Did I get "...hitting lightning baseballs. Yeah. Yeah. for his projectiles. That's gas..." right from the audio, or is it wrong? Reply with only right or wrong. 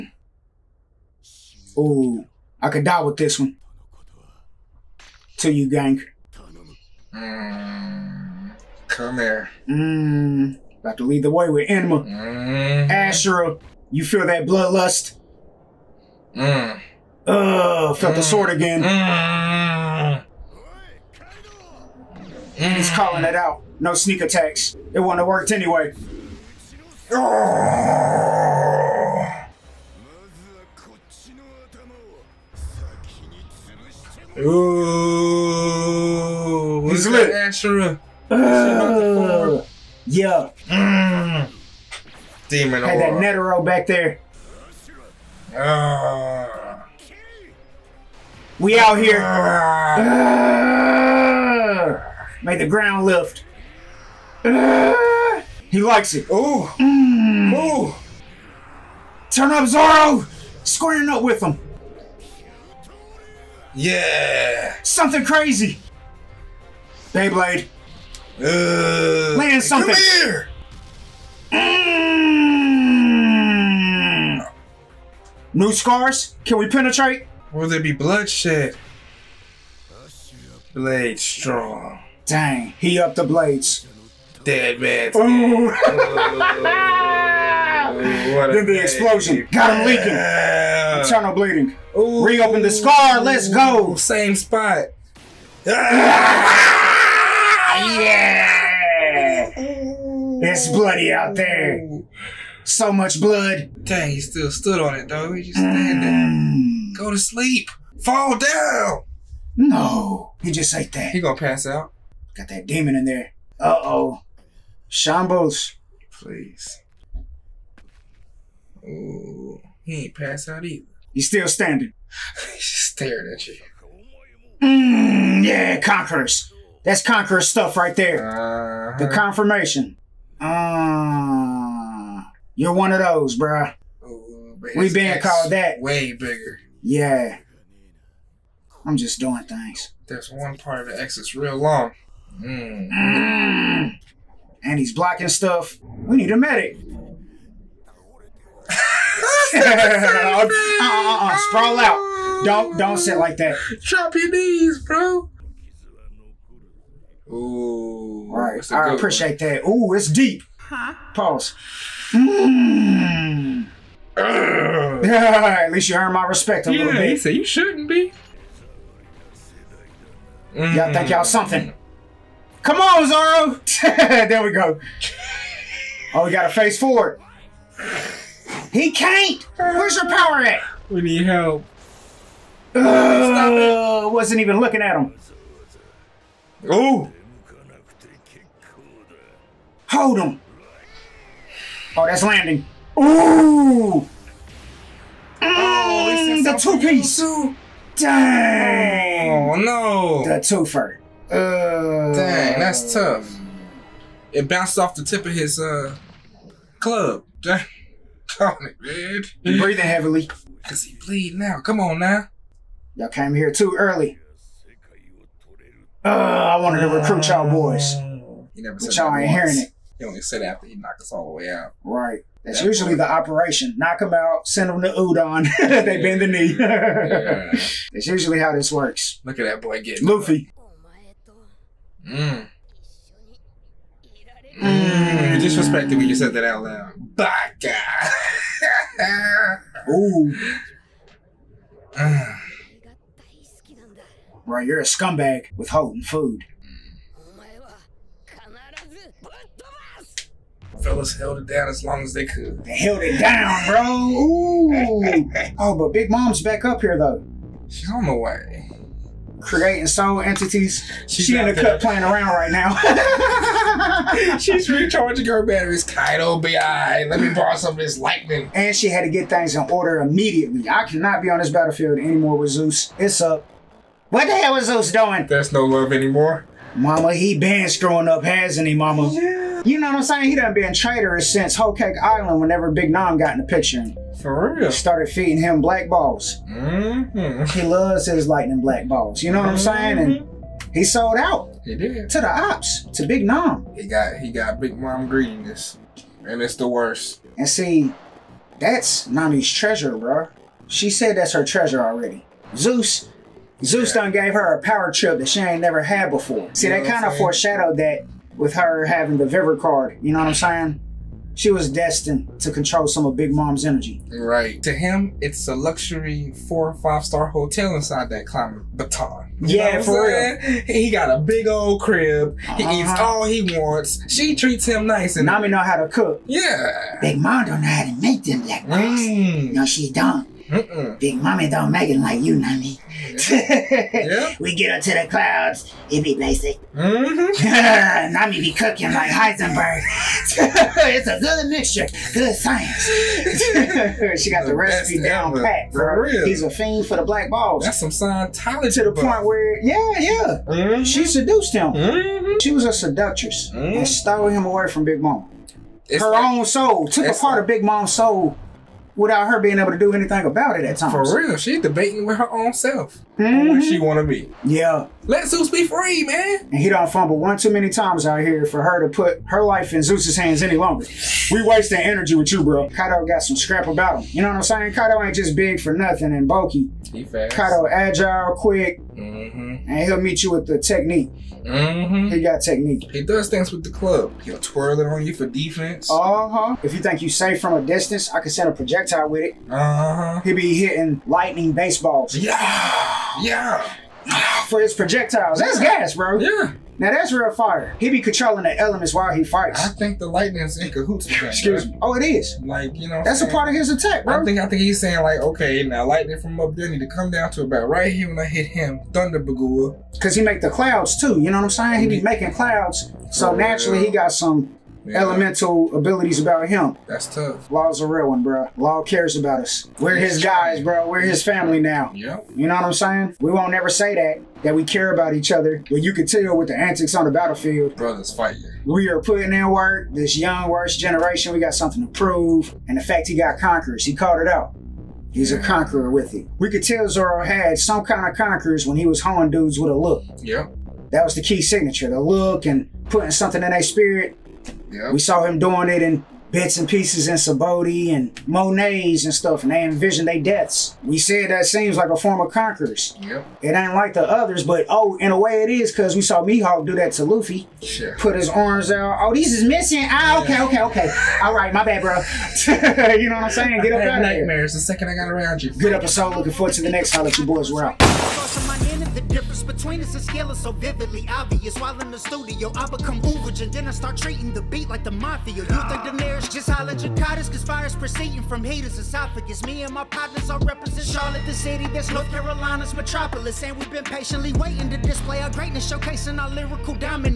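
right.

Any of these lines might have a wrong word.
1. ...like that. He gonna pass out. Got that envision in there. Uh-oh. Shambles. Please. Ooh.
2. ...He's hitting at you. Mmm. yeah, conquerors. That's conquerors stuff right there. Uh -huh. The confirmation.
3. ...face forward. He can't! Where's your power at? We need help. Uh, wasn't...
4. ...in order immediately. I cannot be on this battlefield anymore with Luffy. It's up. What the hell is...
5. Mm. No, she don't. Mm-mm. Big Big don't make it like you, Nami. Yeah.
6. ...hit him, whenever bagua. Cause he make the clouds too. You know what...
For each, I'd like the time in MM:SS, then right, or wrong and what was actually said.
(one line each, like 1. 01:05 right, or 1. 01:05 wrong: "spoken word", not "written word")
1. 01:50 wrong: "demon", not "envision"
2. 02:02 wrong: "staring", not "hitting"
3. 02:56 right
4. 04:29 wrong: "Zeus", not "Luffy"
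5. 05:28 wrong: "Mommy", not "Big"
6. 06:48 wrong: "thunder", not "whenever".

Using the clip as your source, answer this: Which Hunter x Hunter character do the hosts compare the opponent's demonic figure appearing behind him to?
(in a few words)
Netero.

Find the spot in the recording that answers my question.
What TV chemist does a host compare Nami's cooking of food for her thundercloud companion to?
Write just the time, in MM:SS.
05:39.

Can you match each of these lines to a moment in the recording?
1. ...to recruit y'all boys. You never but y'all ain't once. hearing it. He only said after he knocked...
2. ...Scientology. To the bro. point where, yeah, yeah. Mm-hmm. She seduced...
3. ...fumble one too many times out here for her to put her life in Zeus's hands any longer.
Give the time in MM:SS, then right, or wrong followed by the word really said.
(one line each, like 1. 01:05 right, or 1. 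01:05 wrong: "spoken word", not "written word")
1. 03:36 right
2. 05:47 right
3. 06:06 right.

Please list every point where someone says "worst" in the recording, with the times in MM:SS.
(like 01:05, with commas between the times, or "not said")
04:56, 07:10.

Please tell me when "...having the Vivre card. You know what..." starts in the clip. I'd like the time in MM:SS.
05:08.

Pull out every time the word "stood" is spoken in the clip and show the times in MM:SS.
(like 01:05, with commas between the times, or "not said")
01:44.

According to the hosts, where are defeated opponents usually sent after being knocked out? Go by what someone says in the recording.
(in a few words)
Udon.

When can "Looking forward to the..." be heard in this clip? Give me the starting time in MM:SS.
07:46.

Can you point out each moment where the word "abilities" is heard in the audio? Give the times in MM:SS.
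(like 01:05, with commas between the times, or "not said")
06:55.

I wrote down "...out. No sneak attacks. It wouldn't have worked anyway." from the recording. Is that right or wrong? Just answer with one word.
right.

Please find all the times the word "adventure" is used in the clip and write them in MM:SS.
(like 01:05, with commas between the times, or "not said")
not said.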